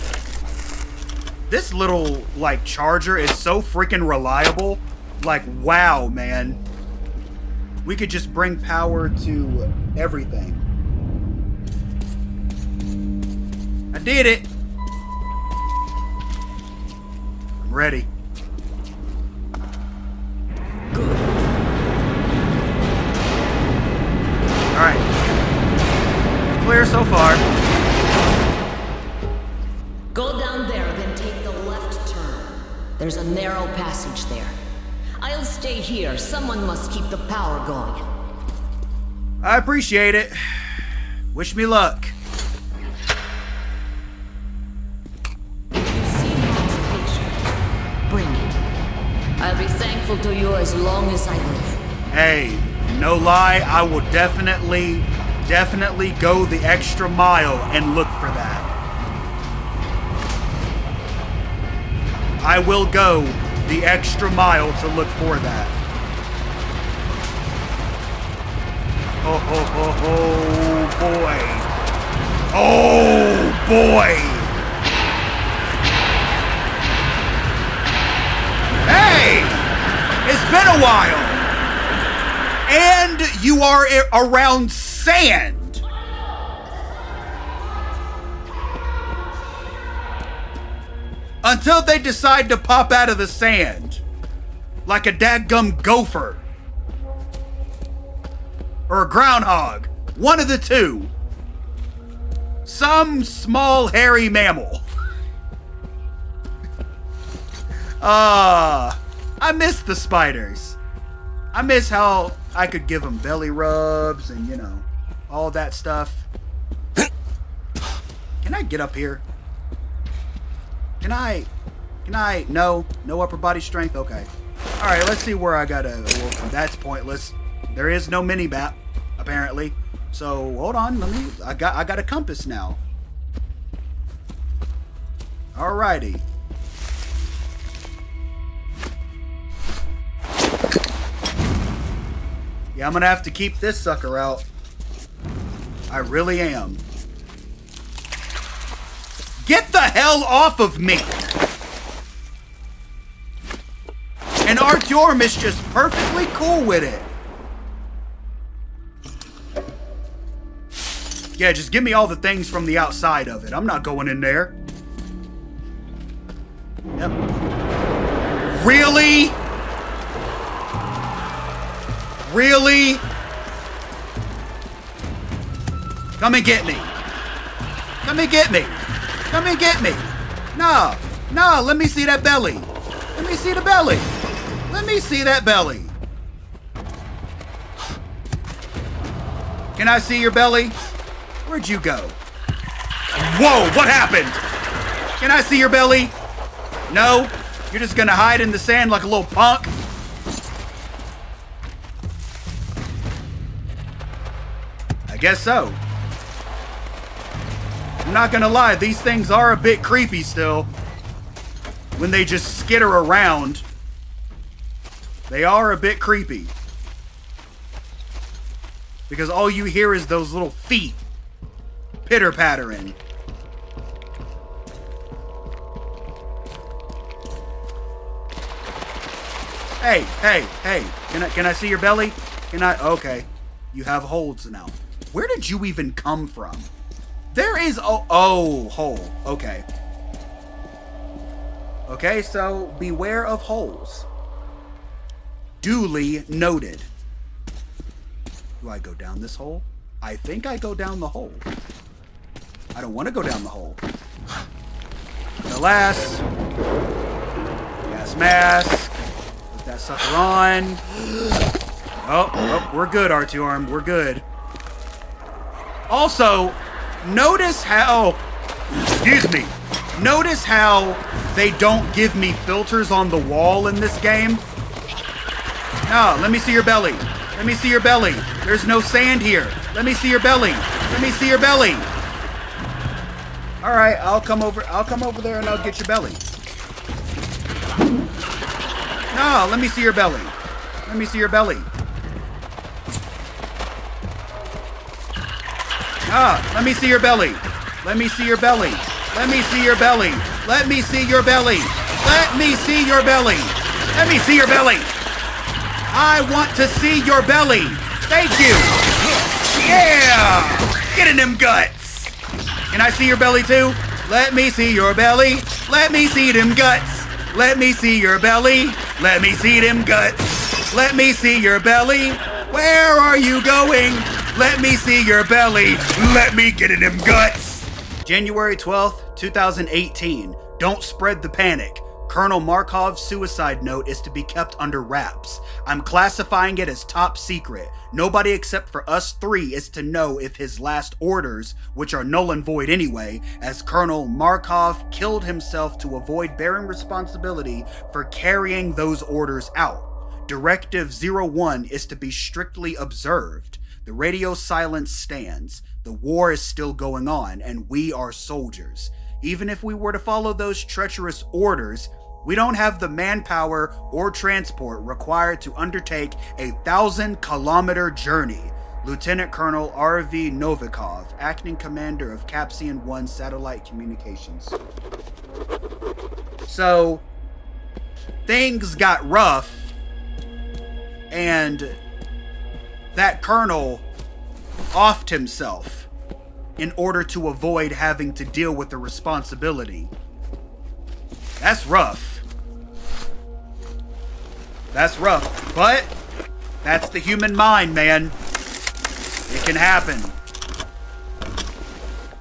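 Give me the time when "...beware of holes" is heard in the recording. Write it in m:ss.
4:02.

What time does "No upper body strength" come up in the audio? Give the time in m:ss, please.
2:03.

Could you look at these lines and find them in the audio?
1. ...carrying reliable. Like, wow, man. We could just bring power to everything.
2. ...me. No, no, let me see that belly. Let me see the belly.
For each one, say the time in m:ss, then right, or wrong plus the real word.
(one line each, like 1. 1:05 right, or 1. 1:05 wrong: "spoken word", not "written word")
1. 0:03 wrong: "freaking", not "carrying"
2. 2:59 right.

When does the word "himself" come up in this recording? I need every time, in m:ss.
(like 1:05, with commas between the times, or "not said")
5:45, 6:25.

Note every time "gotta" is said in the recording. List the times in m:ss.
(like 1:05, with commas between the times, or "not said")
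not said.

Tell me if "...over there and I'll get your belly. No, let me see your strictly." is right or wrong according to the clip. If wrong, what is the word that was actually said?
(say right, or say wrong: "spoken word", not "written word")
wrong: "belly", not "strictly".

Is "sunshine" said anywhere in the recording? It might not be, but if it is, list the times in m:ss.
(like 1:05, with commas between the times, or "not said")
not said.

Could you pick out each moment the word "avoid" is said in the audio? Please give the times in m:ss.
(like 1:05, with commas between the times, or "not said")
5:45, 6:27.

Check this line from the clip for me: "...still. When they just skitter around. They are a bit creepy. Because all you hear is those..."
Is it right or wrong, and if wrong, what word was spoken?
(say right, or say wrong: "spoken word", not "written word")
right.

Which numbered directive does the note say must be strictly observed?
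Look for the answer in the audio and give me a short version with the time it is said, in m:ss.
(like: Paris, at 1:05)
Directive 01, at 5:50.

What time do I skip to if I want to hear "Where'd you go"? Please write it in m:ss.
3:11.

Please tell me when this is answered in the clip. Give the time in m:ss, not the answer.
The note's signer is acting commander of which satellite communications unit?
6:12.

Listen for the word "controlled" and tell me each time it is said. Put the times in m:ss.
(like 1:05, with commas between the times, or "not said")
not said.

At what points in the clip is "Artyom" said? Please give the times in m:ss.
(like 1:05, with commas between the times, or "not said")
2:34, 4:23.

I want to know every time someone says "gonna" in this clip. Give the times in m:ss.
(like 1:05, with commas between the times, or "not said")
2:22, 3:17, 3:28.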